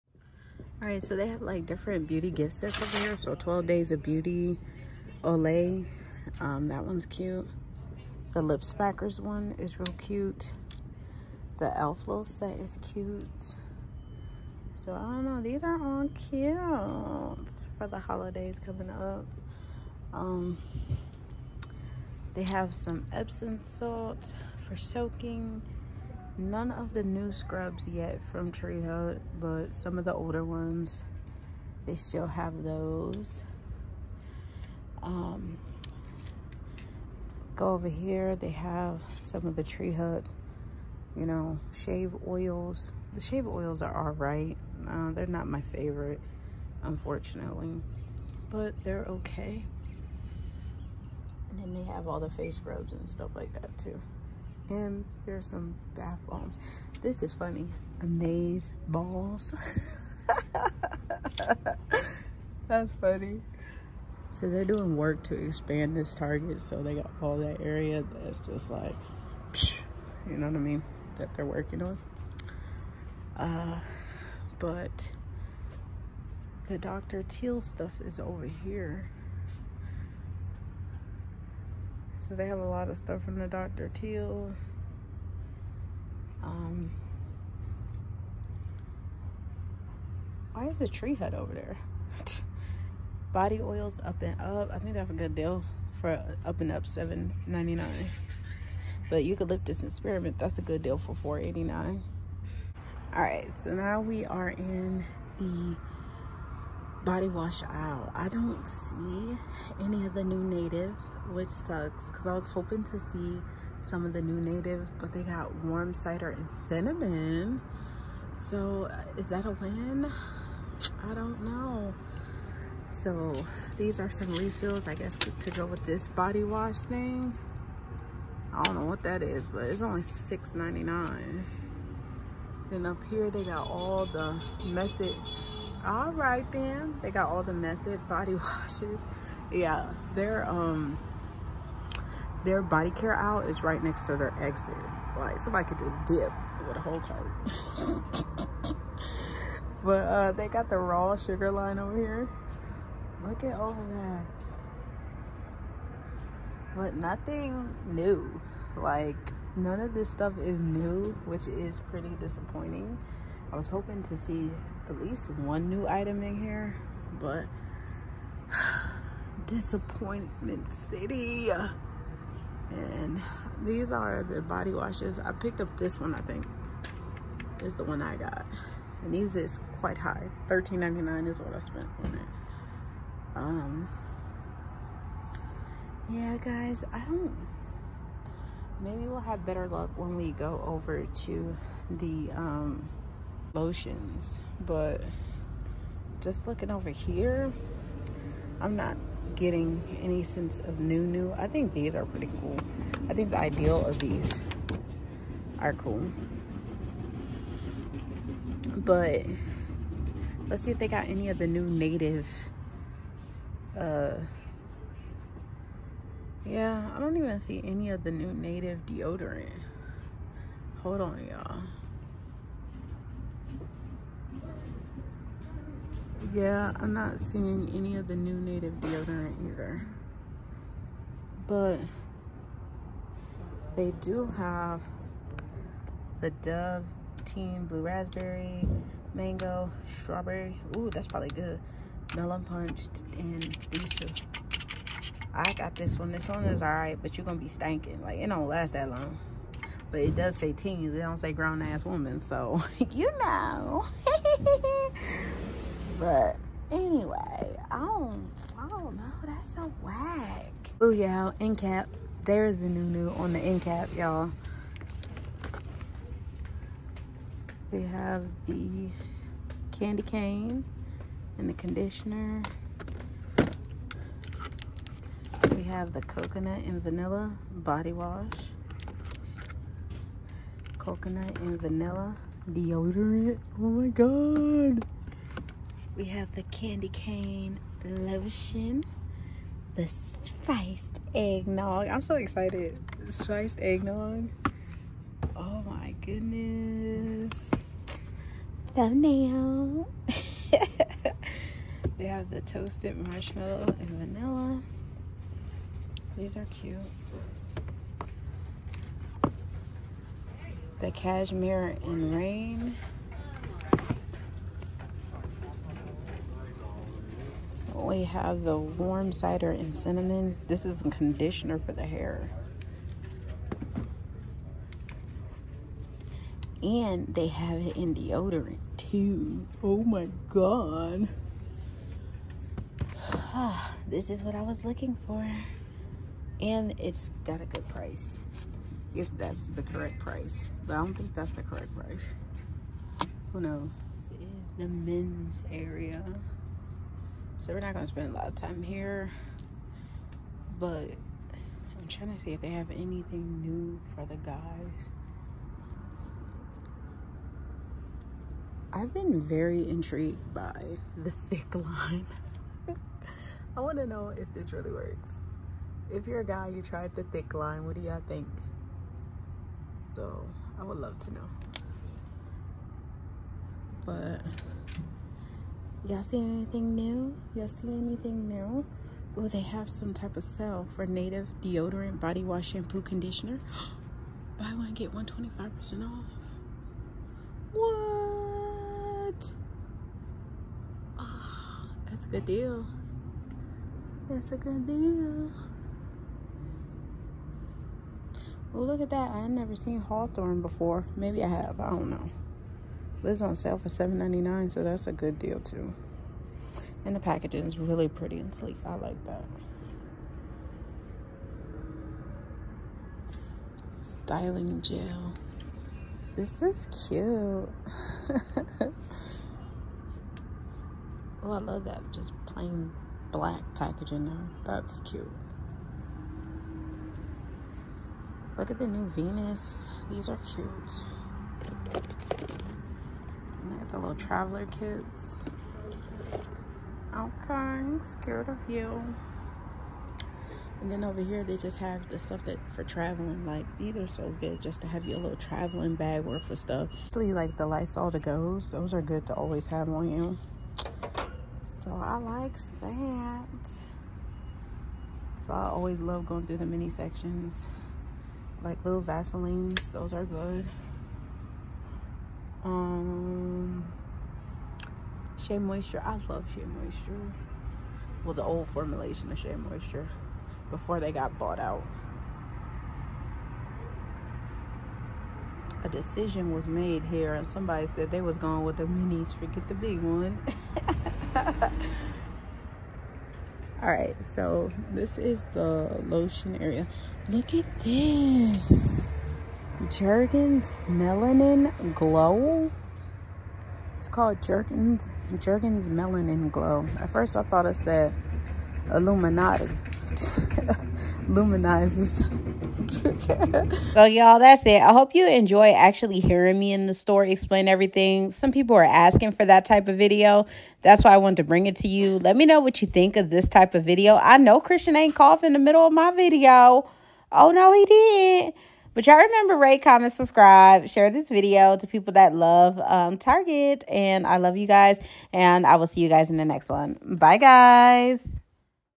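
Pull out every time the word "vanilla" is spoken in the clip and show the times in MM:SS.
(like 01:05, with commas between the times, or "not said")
04:36, 04:41, 05:03.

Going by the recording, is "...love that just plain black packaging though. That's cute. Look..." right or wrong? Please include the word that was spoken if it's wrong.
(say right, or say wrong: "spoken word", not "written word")
right.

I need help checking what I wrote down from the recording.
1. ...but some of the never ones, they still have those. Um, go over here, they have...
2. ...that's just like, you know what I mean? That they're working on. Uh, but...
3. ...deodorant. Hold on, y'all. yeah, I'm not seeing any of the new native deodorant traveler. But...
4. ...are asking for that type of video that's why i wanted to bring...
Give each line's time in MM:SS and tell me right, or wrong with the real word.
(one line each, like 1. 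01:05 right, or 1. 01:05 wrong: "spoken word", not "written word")
1. 00:29 wrong: "older", not "never"
2. 01:08 right
3. 03:38 wrong: "either", not "traveler"
4. 08:28 right.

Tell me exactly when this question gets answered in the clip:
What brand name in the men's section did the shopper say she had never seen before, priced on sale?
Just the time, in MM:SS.
06:39.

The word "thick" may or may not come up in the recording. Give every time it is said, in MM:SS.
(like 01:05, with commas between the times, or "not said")
06:01, 06:07.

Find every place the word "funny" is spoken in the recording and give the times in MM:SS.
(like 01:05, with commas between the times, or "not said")
00:57, 01:03.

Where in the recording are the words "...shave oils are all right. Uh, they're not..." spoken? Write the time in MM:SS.
00:43.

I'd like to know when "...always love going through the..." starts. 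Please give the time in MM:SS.
07:35.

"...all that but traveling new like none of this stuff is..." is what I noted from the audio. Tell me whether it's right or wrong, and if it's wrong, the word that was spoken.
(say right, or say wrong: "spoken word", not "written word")
wrong: "nothing", not "traveling".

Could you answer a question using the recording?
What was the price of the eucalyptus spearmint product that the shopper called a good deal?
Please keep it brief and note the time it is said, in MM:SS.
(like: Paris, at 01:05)
$4.89, at 01:41.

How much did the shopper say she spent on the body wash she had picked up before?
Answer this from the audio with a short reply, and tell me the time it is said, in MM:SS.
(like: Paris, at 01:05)
$13.99, at 03:00.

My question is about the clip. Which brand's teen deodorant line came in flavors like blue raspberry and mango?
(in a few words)
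Dove.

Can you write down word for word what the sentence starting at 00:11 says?
The Elf Little set is cute.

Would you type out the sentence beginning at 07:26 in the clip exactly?
Especially like the Lysol to goes.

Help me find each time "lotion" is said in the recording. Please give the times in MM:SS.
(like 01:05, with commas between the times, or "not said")
03:13, 04:47, 08:05.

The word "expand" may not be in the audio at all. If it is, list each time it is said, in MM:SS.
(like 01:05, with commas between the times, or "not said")
01:05.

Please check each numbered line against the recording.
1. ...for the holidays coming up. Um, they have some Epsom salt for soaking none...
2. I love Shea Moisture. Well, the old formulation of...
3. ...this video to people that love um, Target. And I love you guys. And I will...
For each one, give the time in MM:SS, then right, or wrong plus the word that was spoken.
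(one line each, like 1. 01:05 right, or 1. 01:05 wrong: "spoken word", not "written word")
1. 00:17 right
2. 07:45 right
3. 08:40 right.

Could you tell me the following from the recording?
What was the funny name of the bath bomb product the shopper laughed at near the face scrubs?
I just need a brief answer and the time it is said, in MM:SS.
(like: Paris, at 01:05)
Amaze balls, at 00:58.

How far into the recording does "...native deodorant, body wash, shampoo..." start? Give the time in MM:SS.
06:20.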